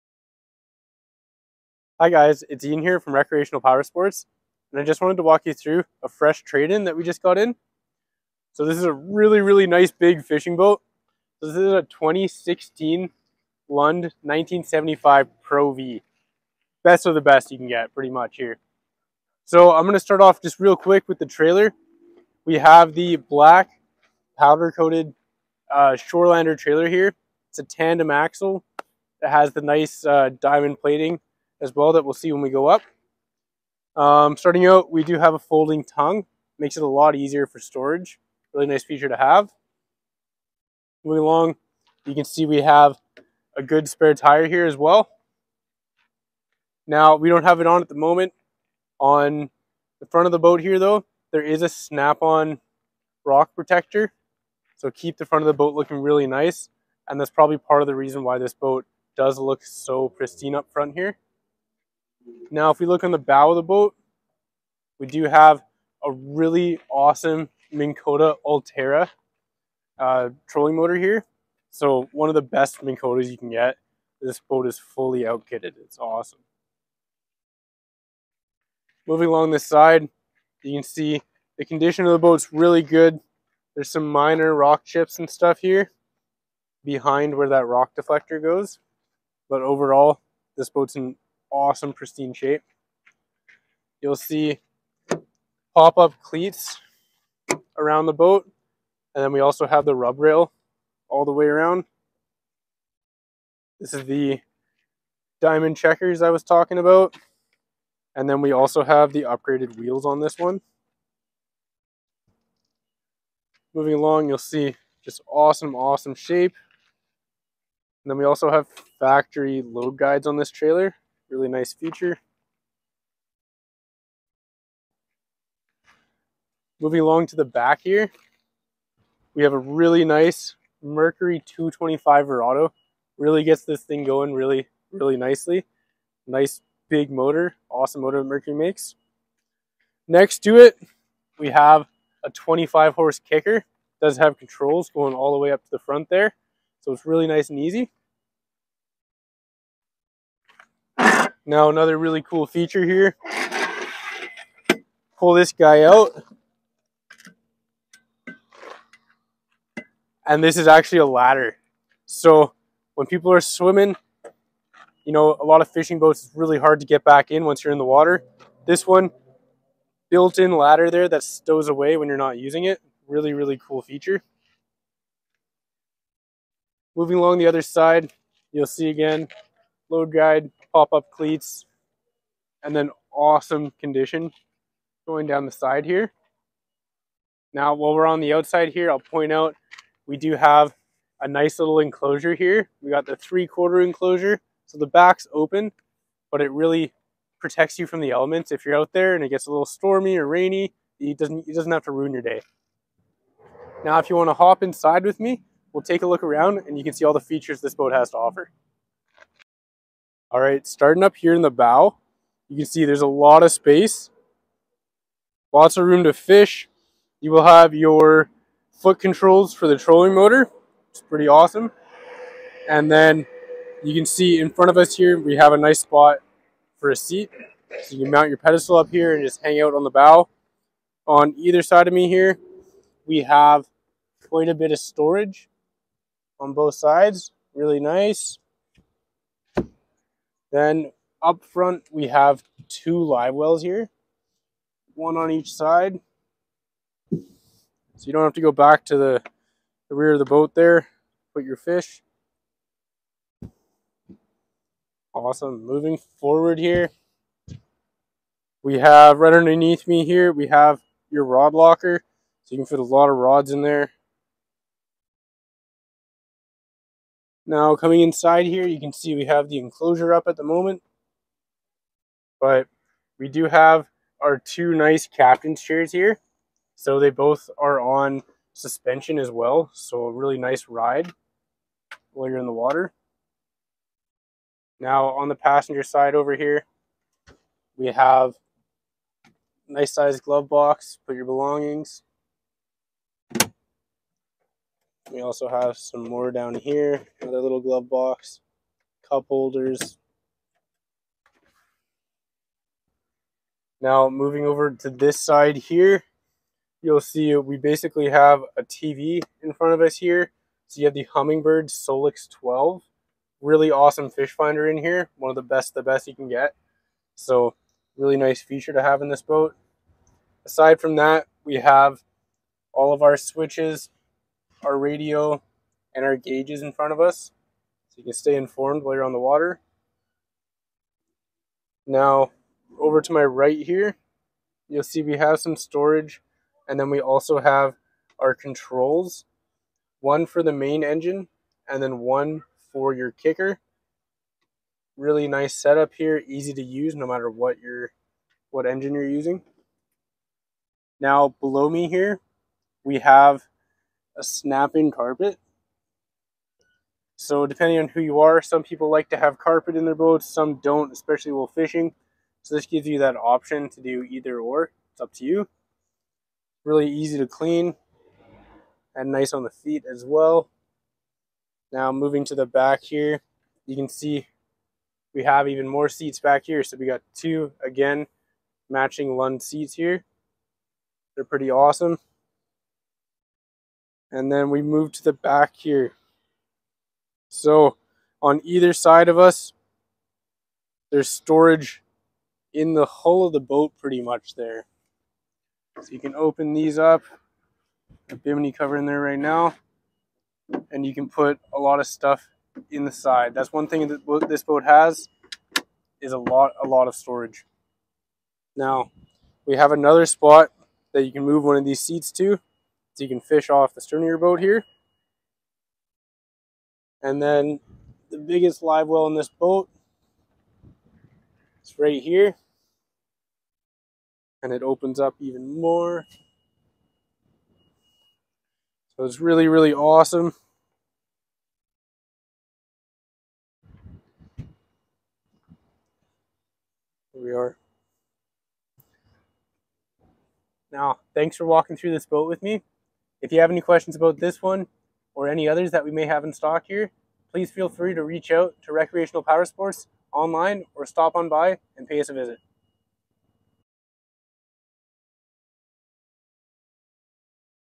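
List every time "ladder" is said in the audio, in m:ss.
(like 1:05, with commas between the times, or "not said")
2:41, 2:50.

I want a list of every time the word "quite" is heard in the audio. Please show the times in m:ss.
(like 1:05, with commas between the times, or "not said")
3:54.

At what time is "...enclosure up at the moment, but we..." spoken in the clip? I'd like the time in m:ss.
4:29.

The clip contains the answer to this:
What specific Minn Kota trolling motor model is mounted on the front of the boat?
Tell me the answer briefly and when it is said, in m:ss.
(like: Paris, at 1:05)
Ulterra, at 1:08.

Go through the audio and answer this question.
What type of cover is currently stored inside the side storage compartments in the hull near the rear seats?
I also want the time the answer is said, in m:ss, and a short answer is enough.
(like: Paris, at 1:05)
bimini cover, at 6:38.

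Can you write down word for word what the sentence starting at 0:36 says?
Makes it a lot easier for storage.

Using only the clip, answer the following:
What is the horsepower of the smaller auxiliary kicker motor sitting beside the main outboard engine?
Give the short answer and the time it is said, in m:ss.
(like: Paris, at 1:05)
25, at 2:22.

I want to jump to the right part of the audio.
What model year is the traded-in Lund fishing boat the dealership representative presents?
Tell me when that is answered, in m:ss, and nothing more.
0:11.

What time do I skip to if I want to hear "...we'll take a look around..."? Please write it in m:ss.
3:25.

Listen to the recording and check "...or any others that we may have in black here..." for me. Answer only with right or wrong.
wrong.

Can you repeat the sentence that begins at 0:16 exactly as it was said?
Best of the best you can get, pretty much here.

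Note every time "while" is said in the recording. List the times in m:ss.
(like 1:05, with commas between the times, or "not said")
3:07, 4:42, 5:28, 6:01.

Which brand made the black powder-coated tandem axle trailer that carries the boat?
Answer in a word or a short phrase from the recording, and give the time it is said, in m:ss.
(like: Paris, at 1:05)
Shorelander, at 0:26.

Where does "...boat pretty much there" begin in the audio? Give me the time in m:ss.
6:33.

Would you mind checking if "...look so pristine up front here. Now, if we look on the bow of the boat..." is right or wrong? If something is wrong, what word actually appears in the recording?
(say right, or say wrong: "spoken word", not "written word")
right.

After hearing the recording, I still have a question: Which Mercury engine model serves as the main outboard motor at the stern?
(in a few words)
225 Verado.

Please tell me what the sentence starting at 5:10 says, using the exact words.
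So you have the Humminbird Solix 12.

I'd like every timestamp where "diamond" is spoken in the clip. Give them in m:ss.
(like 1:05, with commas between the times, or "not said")
0:30, 1:45.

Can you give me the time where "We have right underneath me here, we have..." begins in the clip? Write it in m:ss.
4:18.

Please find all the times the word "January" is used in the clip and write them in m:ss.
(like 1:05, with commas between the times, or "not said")
not said.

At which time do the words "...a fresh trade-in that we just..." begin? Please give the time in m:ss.
0:06.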